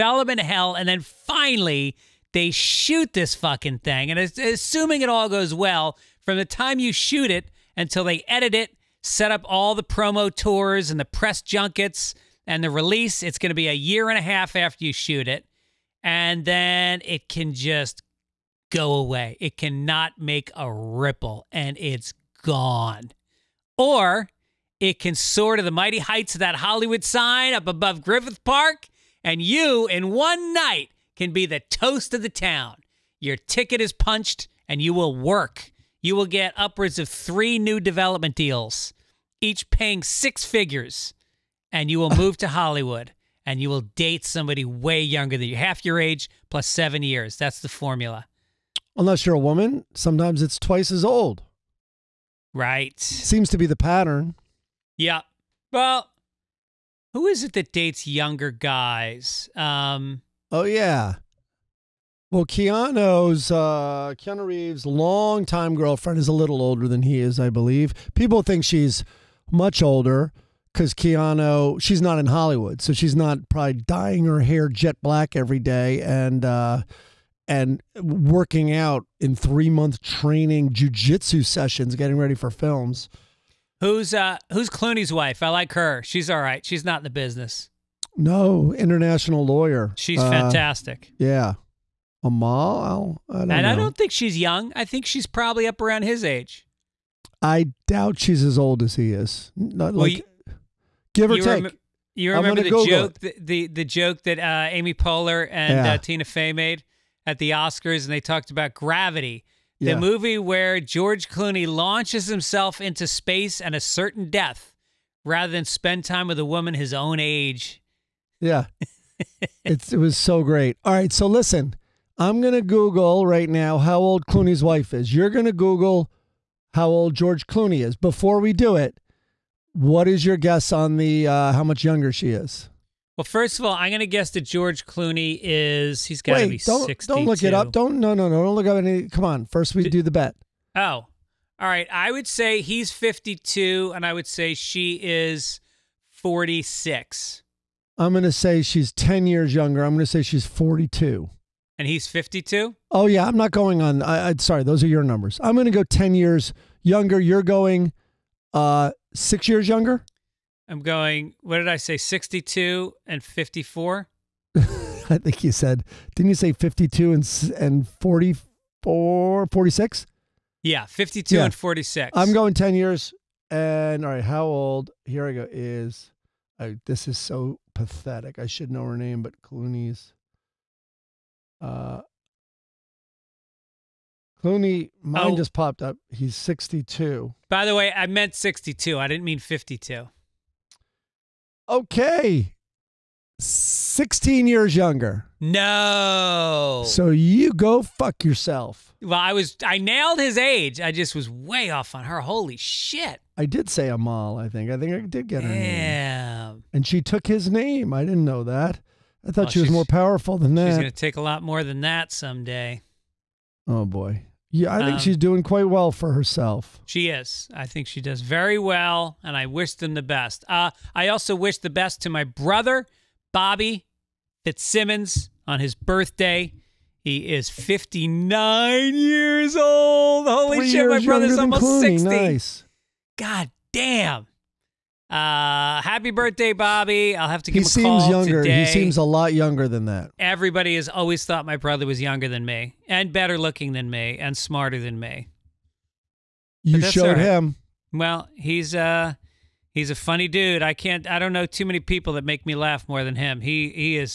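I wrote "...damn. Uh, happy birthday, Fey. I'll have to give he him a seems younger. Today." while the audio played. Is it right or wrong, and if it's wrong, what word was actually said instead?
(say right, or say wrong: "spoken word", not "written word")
wrong: "Bobby", not "Fey".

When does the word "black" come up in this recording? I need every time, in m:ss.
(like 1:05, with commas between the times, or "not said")
1:15.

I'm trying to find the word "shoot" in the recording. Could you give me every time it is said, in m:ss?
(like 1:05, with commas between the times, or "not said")
0:02, 0:06, 0:14.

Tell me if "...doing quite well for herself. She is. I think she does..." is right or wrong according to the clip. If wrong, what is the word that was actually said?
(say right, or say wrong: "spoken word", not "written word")
right.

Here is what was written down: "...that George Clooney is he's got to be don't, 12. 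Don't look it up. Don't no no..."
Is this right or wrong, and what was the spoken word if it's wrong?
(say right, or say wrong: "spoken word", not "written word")
wrong: "62", not "12".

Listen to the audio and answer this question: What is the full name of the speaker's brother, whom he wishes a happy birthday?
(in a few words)
Bobby Fitzsimmons.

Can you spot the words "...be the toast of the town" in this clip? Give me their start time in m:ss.
0:31.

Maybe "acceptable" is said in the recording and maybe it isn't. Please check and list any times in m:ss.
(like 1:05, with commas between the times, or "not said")
not said.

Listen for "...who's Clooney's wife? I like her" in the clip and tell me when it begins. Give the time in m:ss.
1:24.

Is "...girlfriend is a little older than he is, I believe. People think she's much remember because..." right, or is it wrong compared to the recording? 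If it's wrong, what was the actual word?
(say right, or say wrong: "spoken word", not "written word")
wrong: "older", not "remember".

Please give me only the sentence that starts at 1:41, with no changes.
Rem- you remember the Google joke, the, the, the joke that uh, Amy Poehler and uh, yeah.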